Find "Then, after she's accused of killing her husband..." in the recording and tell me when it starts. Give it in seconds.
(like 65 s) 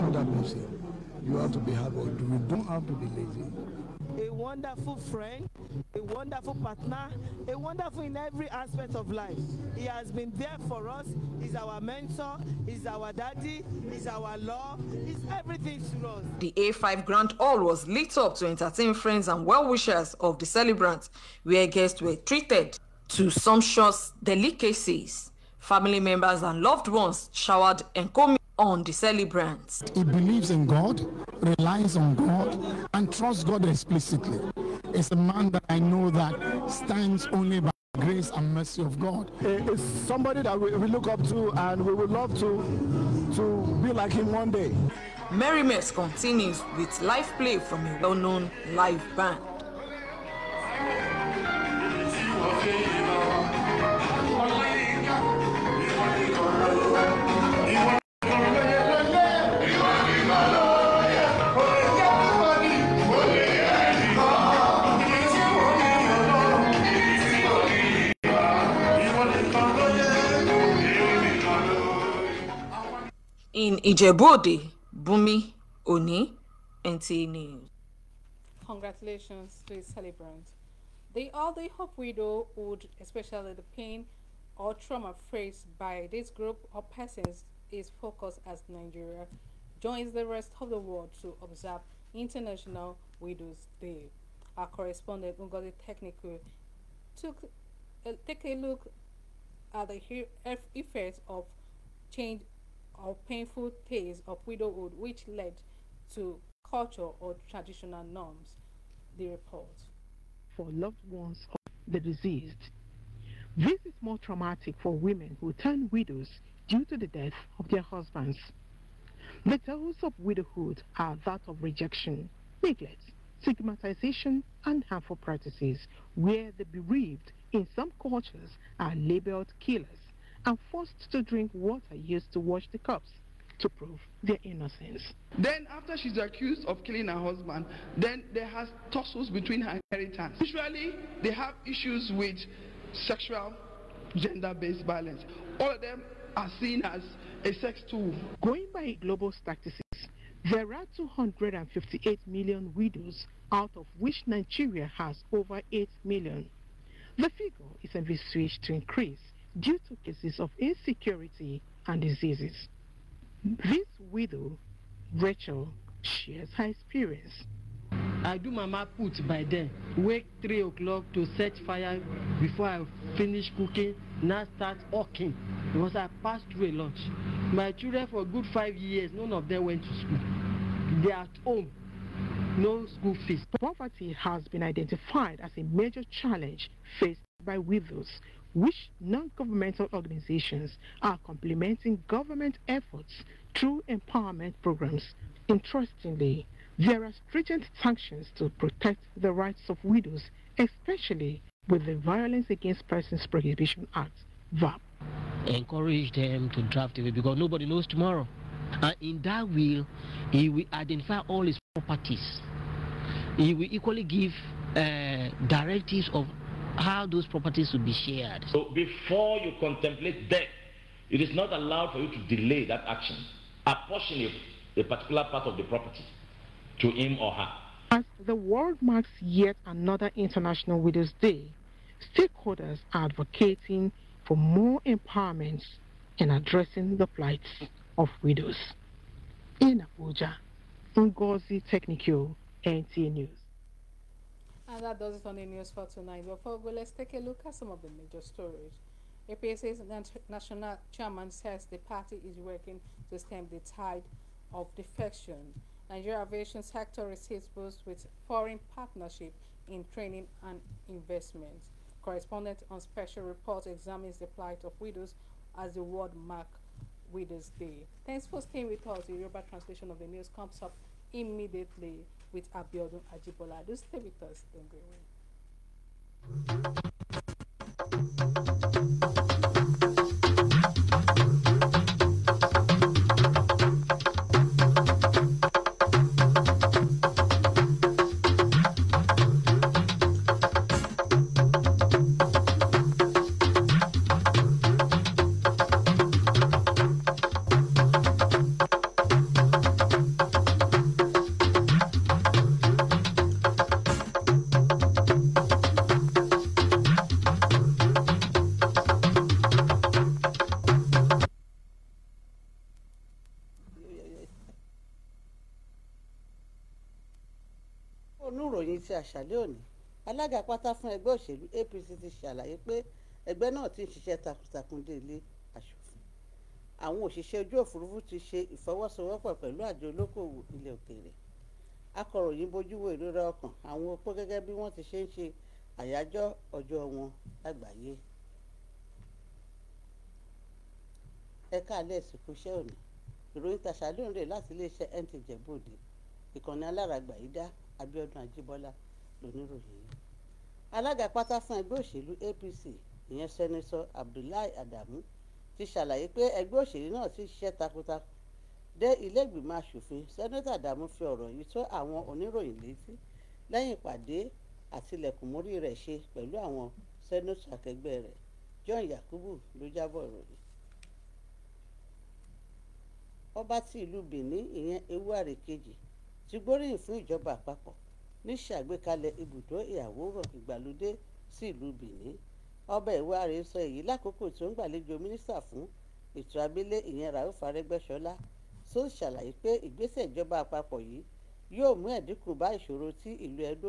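135 s.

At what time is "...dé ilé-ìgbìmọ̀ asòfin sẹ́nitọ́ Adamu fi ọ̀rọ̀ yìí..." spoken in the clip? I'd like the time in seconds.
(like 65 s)
358 s.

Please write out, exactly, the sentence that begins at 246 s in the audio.
Before we go, let's take a look at some of the major stories.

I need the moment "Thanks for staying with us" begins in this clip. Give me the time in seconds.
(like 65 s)
268 s.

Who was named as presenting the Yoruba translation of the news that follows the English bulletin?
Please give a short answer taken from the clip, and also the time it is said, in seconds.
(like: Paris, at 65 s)
Abiodun Ajibola, at 272 s.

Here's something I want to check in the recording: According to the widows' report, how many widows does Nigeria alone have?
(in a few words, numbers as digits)
over 8 million.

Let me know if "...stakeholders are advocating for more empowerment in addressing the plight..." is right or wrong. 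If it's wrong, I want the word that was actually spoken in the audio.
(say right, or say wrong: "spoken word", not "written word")
right.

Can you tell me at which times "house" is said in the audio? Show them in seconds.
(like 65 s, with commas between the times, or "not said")
not said.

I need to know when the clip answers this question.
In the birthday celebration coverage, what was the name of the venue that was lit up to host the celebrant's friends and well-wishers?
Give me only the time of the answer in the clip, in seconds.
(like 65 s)
16 s.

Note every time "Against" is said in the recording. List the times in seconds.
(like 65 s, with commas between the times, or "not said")
202 s.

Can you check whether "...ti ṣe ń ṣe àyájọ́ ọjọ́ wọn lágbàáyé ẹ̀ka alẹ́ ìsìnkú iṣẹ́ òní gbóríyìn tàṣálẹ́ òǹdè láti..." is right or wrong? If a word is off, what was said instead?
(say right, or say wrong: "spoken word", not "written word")
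wrong: "ìròyìn", not "gbóríyìn".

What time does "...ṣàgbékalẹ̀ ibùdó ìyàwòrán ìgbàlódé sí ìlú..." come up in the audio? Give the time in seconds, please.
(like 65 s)
378 s.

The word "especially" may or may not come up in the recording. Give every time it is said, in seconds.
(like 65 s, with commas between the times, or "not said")
82 s, 200 s.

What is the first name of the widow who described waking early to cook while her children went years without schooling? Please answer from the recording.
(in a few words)
Rachel.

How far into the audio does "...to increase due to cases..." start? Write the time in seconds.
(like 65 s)
158 s.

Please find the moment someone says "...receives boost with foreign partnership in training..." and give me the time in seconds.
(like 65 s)
257 s.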